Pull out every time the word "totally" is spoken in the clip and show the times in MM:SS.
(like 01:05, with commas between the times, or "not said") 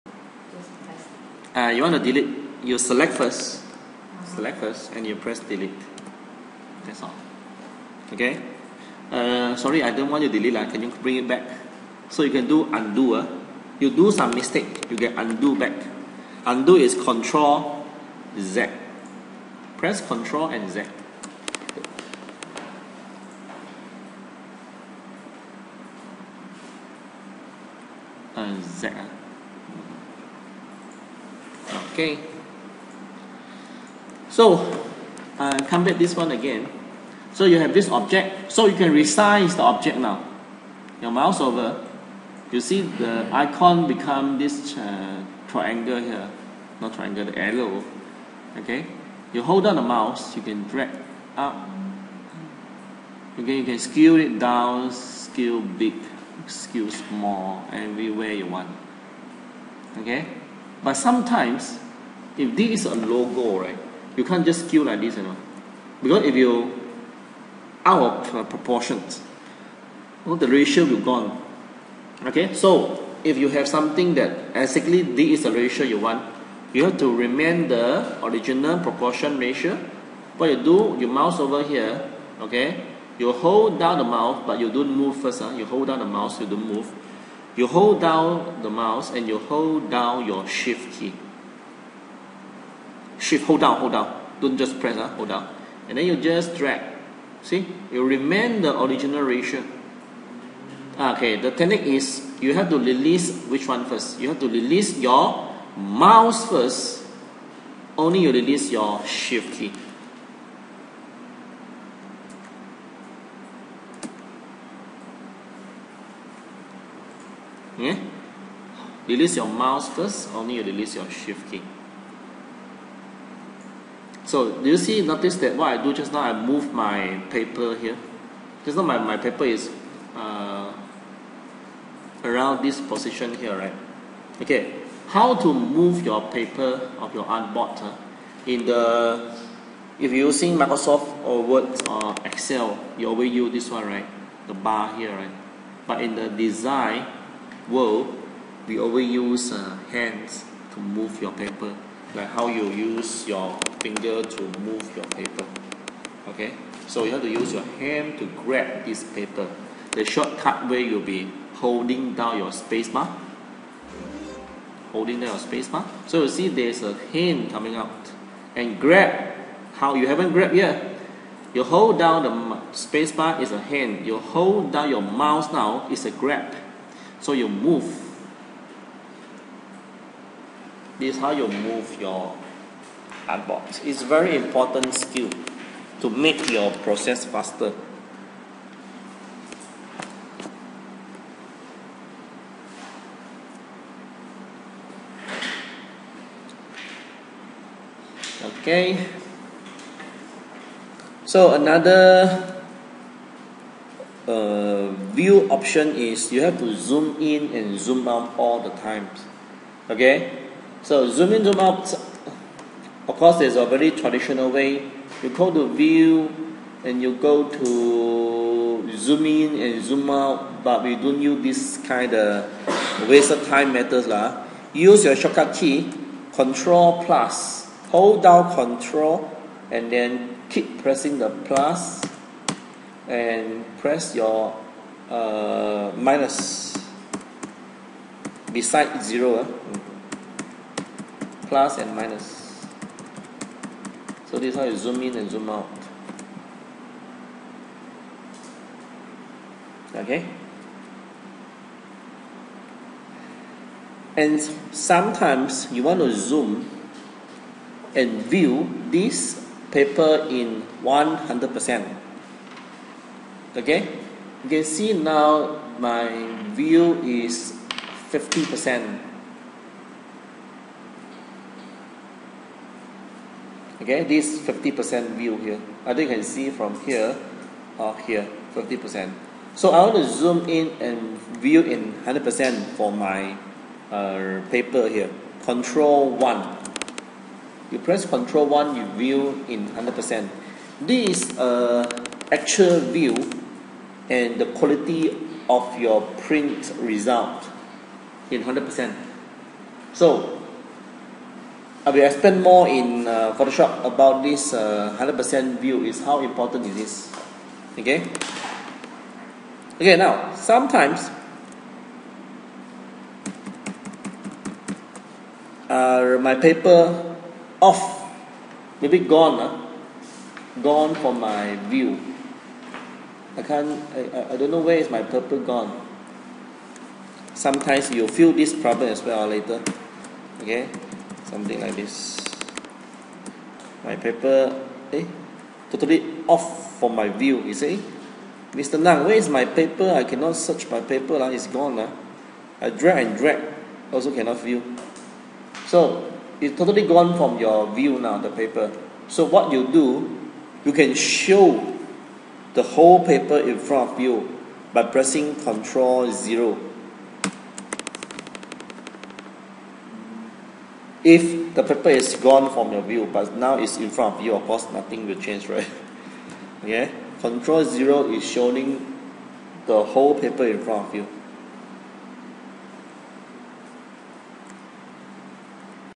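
05:35, 05:46.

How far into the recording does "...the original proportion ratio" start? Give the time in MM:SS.
01:17.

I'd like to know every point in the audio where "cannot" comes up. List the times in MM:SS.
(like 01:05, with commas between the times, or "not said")
05:40, 05:44.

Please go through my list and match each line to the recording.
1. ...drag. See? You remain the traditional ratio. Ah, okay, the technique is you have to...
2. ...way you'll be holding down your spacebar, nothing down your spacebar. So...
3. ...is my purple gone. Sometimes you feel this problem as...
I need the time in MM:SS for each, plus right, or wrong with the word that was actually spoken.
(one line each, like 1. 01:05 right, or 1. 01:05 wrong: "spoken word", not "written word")
1. 01:36 wrong: "original", not "traditional"
2. 02:40 wrong: "holding", not "nothing"
3. 05:24 right.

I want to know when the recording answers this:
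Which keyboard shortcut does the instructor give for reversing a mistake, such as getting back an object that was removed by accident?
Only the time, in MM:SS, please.
00:16.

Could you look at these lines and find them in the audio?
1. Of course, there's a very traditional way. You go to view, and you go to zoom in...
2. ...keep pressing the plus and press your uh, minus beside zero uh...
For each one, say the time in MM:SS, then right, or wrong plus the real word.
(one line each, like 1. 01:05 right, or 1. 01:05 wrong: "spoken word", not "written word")
1. 03:33 right
2. 03:50 right.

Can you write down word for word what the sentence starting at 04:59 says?
So, I will explain more in uh, Photoshop about this uh, 100% view is how important it is.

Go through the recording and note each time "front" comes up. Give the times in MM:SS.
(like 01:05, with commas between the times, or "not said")
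05:53, 06:03, 06:10.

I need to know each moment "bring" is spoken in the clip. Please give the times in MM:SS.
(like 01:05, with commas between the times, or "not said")
00:11.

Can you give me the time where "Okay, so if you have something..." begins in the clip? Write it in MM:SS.
01:12.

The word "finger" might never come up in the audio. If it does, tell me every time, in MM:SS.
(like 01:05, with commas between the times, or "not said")
02:33.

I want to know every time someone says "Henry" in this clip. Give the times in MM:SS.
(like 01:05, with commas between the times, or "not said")
not said.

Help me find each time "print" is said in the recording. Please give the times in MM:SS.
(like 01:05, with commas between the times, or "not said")
04:56.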